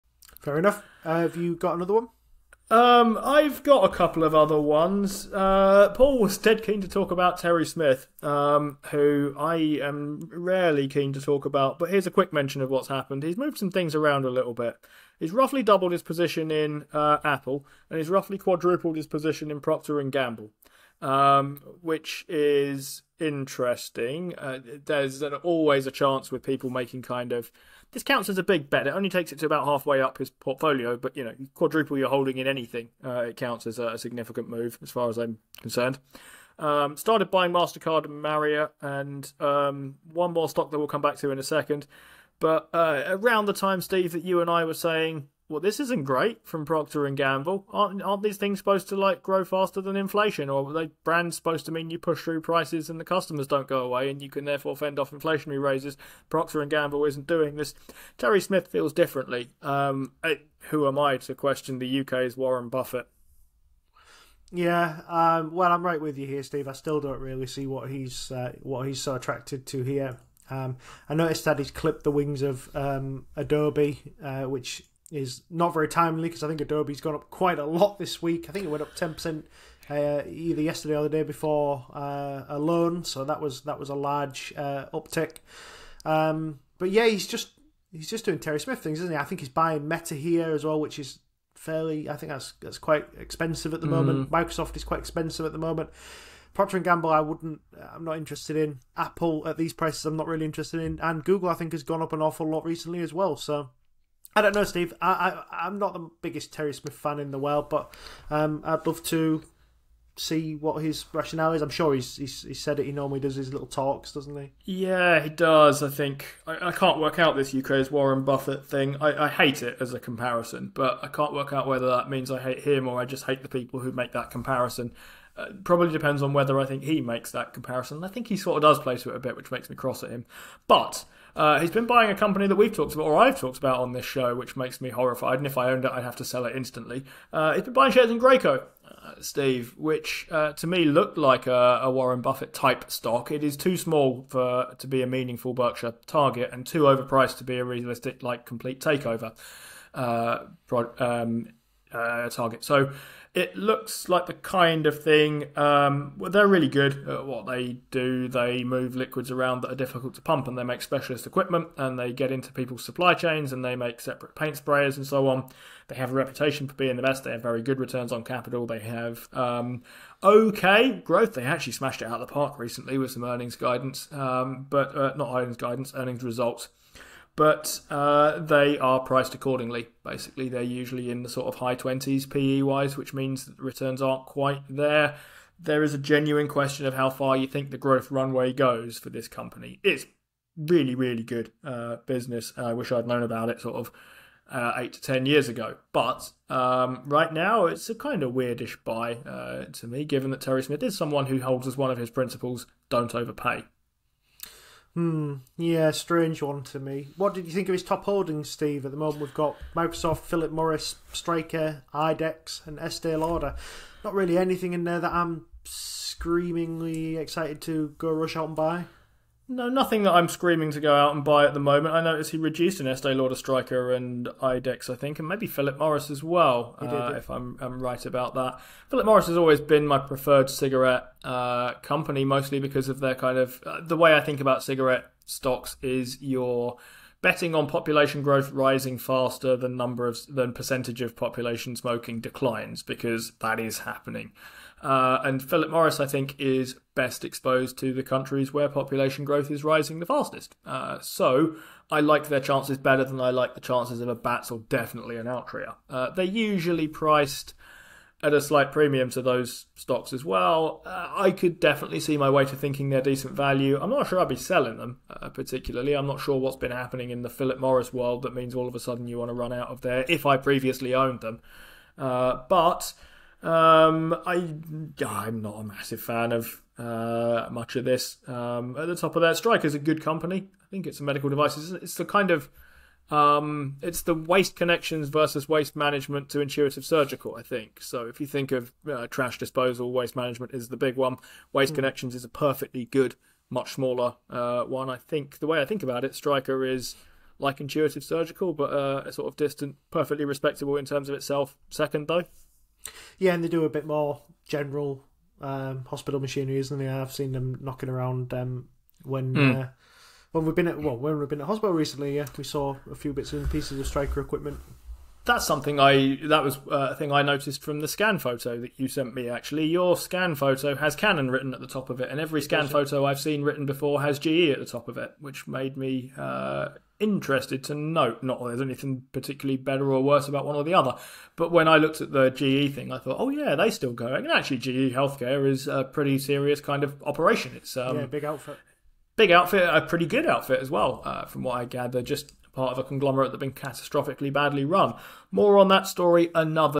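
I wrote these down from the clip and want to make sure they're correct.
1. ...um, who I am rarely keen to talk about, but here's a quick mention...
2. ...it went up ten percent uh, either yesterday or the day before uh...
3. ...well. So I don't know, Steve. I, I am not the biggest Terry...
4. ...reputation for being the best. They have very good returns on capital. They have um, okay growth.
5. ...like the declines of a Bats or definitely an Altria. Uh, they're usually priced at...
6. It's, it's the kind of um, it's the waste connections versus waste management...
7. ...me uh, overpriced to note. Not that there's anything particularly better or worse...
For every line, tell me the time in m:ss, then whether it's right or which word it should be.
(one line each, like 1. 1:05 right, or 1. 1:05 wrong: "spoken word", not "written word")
1. 0:08 right
2. 1:18 right
3. 1:43 right
4. 2:46 right
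5. 4:13 wrong: "chances", not "declines"
6. 4:41 right
7. 5:25 wrong: "interested", not "overpriced".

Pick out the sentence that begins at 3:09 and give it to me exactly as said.
It's really, really good uh, business.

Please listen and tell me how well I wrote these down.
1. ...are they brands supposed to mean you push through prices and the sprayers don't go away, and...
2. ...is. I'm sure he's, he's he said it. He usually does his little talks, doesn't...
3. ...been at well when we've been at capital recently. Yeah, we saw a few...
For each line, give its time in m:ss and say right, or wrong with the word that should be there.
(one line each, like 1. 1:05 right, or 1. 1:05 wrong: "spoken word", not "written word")
1. 0:50 wrong: "customers", not "sprayers"
2. 1:51 wrong: "normally", not "usually"
3. 5:10 wrong: "hospital", not "capital".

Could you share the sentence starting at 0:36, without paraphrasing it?
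Um, started buying Mastercard and Marriott, and um, one more stock that we'll come back to in a second.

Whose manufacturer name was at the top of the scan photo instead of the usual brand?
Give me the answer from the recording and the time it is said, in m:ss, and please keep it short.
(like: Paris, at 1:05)
Canon, at 5:20.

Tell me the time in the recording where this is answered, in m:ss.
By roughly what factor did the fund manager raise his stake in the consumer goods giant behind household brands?
0:18.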